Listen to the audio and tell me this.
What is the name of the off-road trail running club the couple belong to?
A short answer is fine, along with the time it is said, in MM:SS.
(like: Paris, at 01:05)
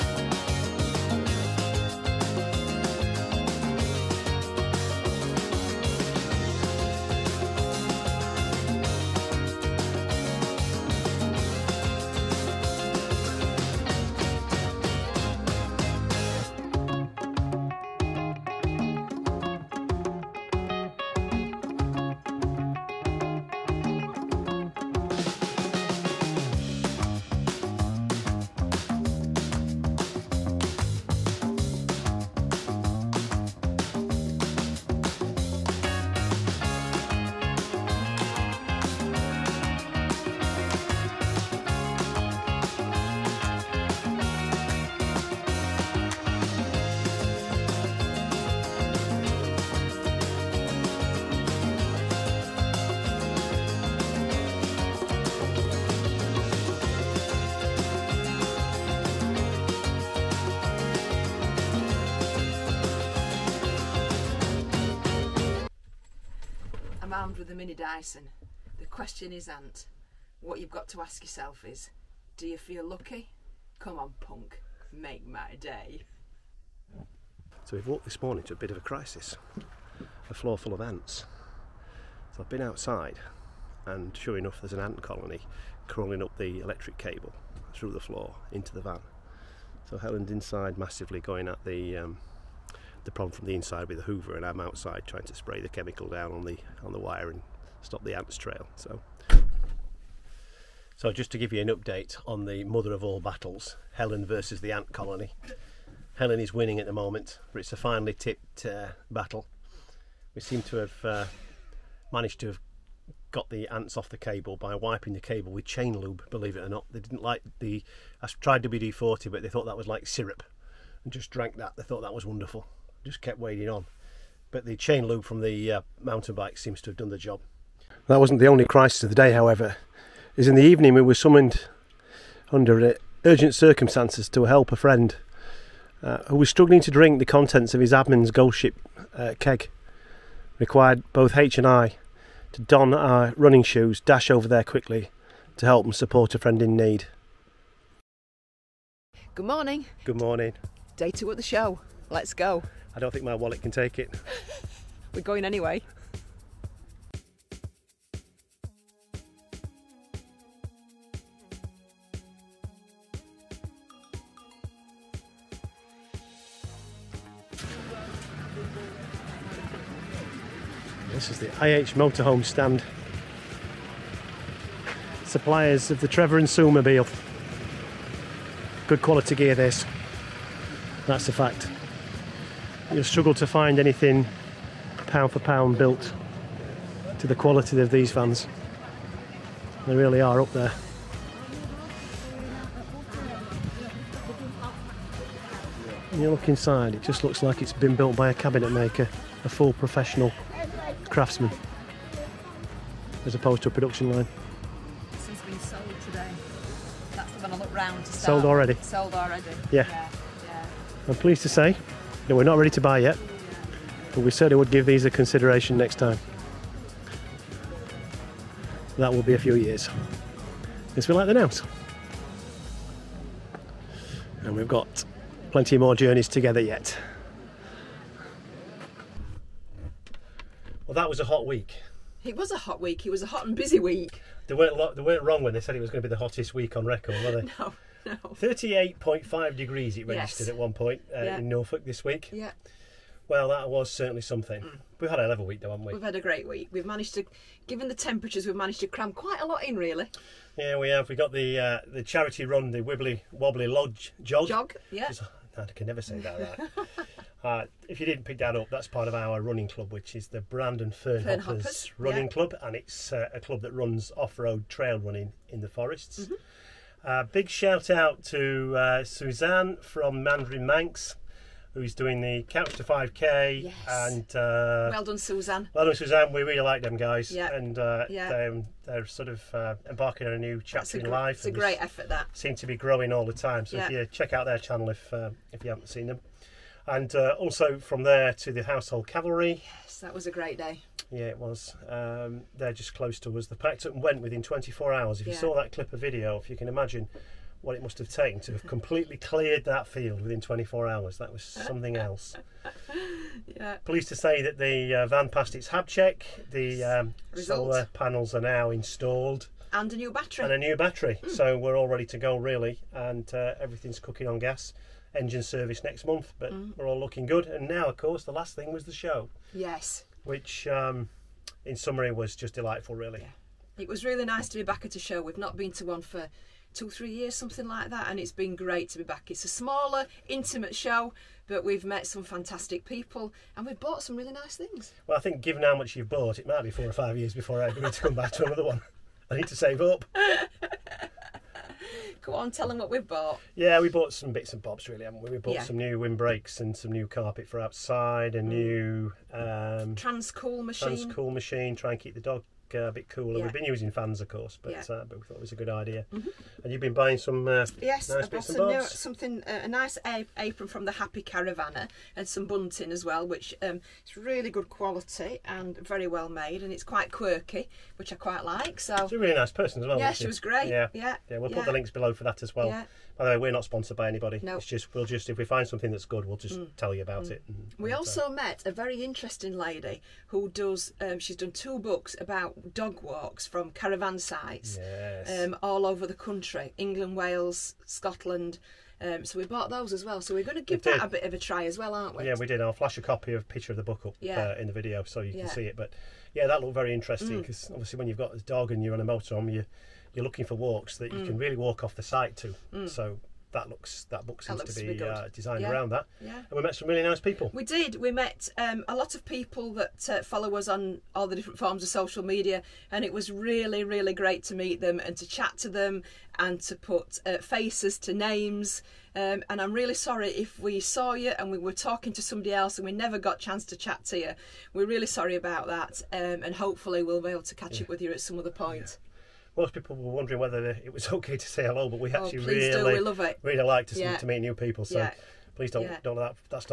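Brandon Fernhoppers, at 04:20.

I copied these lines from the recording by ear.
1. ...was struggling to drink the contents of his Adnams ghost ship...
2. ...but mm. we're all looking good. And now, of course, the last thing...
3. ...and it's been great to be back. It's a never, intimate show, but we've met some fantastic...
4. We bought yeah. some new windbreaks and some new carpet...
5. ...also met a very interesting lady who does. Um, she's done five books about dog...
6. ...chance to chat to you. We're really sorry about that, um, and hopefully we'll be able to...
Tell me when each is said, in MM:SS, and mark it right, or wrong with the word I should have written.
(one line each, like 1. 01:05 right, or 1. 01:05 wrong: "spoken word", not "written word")
1. 02:16 right
2. 05:16 right
3. 05:28 wrong: "smaller", not "never"
4. 05:45 right
5. 06:17 wrong: "two", not "five"
6. 07:03 right.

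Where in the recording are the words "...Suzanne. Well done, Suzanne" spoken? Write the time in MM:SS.
04:35.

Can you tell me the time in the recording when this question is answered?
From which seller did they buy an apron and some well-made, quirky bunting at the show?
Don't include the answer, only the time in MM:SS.
06:00.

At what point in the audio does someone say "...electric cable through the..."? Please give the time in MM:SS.
01:26.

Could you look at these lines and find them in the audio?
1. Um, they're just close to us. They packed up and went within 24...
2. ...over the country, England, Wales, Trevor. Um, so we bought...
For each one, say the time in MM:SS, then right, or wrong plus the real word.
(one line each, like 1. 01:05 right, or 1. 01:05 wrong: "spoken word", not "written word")
1. 04:51 right
2. 06:25 wrong: "Scotland", not "Trevor".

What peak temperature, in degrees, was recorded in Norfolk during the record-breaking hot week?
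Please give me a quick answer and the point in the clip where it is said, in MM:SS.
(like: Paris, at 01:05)
38.5, at 03:58.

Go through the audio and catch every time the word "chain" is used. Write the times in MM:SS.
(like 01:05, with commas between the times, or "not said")
01:55, 02:04.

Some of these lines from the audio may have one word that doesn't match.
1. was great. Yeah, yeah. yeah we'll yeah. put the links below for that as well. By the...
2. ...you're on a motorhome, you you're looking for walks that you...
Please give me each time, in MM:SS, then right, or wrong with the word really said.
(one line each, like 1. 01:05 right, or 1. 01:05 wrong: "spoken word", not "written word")
1. 06:10 right
2. 06:38 right.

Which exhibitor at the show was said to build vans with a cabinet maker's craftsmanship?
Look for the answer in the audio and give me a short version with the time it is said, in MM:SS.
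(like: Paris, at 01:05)
IH Motorhome, at 02:51.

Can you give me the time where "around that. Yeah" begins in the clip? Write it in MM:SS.
06:45.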